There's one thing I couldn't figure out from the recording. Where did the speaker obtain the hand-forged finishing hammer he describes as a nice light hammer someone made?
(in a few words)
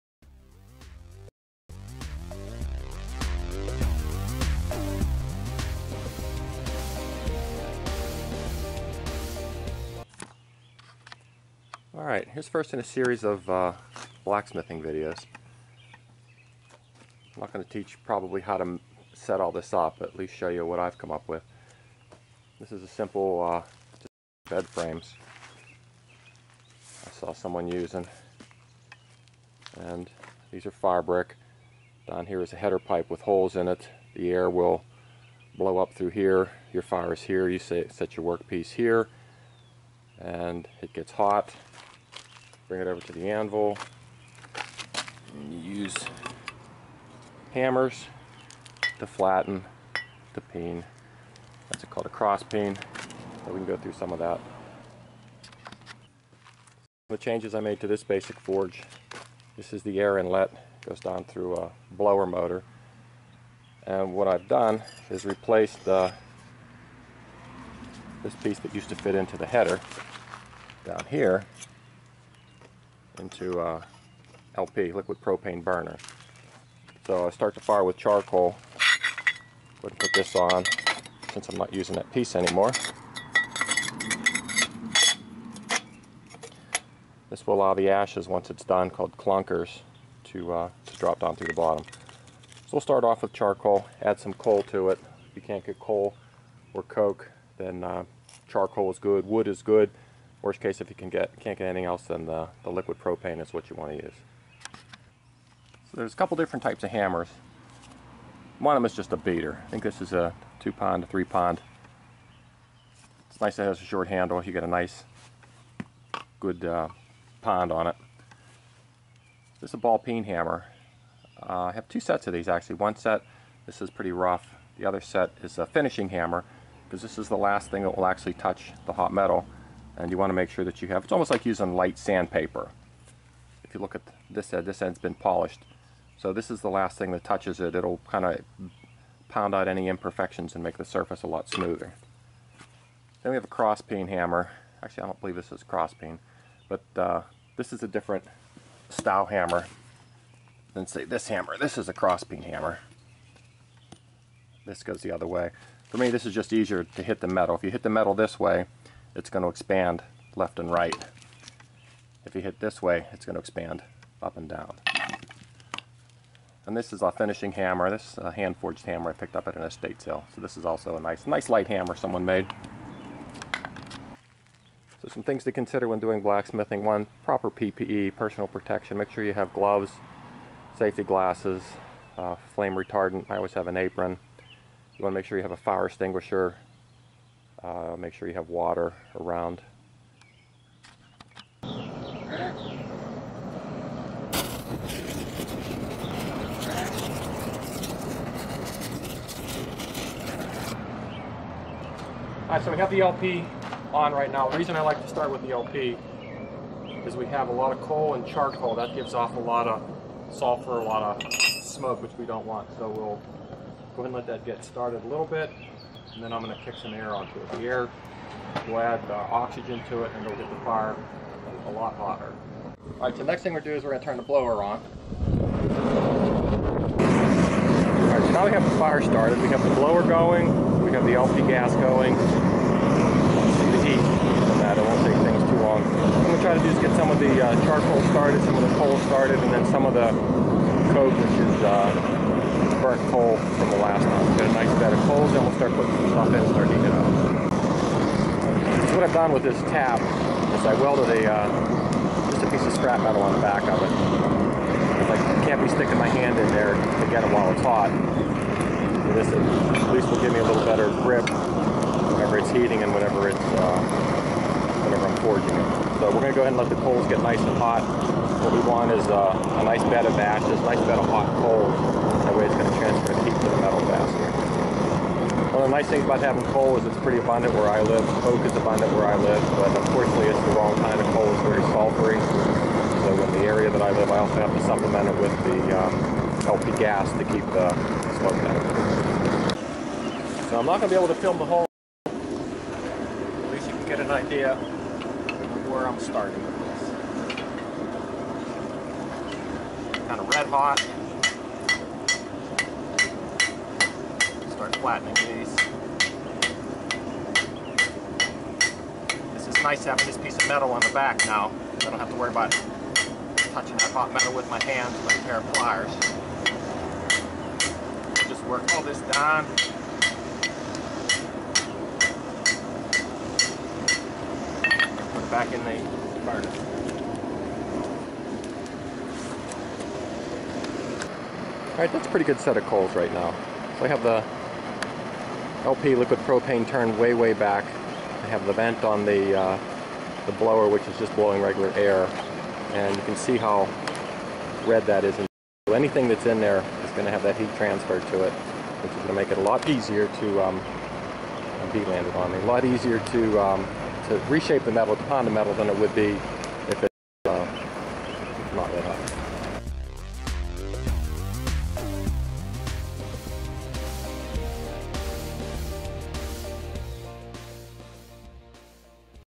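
An estate sale.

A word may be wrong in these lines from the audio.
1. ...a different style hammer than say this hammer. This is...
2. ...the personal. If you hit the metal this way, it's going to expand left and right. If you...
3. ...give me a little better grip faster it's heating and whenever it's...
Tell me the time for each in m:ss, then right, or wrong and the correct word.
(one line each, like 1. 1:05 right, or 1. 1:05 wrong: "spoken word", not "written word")
1. 2:27 right
2. 2:37 wrong: "metal", not "personal"
3. 4:20 wrong: "whenever", not "faster".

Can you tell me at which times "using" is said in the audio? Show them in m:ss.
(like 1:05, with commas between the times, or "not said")
0:27, 1:21, 2:11.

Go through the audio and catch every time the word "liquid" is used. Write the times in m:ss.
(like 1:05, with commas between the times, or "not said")
1:14, 1:42, 5:35.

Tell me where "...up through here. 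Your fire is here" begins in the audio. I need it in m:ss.
0:35.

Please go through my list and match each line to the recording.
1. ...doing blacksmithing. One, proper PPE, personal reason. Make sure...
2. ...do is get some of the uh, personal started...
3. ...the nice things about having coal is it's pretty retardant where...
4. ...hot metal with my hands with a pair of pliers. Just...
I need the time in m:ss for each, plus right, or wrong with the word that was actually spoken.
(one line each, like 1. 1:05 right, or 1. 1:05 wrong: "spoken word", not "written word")
1. 2:55 wrong: "protection", not "reason"
2. 3:56 wrong: "charcoal", not "personal"
3. 4:35 wrong: "abundant", not "retardant"
4. 5:13 right.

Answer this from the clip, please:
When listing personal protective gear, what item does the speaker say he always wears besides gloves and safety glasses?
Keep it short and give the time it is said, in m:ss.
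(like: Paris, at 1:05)
An apron, at 3:03.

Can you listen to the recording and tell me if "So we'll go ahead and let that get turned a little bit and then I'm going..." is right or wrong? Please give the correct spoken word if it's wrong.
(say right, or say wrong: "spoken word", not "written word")
wrong: "started", not "turned".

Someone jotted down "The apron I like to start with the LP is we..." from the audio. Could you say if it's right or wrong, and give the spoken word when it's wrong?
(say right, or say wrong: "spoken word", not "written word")
wrong: "reason", not "apron".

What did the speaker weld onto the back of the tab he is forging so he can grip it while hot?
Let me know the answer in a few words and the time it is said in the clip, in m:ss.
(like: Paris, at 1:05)
A piece of scrap metal, at 4:12.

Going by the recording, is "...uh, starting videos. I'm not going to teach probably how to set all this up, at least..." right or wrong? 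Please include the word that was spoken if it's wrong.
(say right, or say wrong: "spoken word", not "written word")
wrong: "blacksmithing", not "starting".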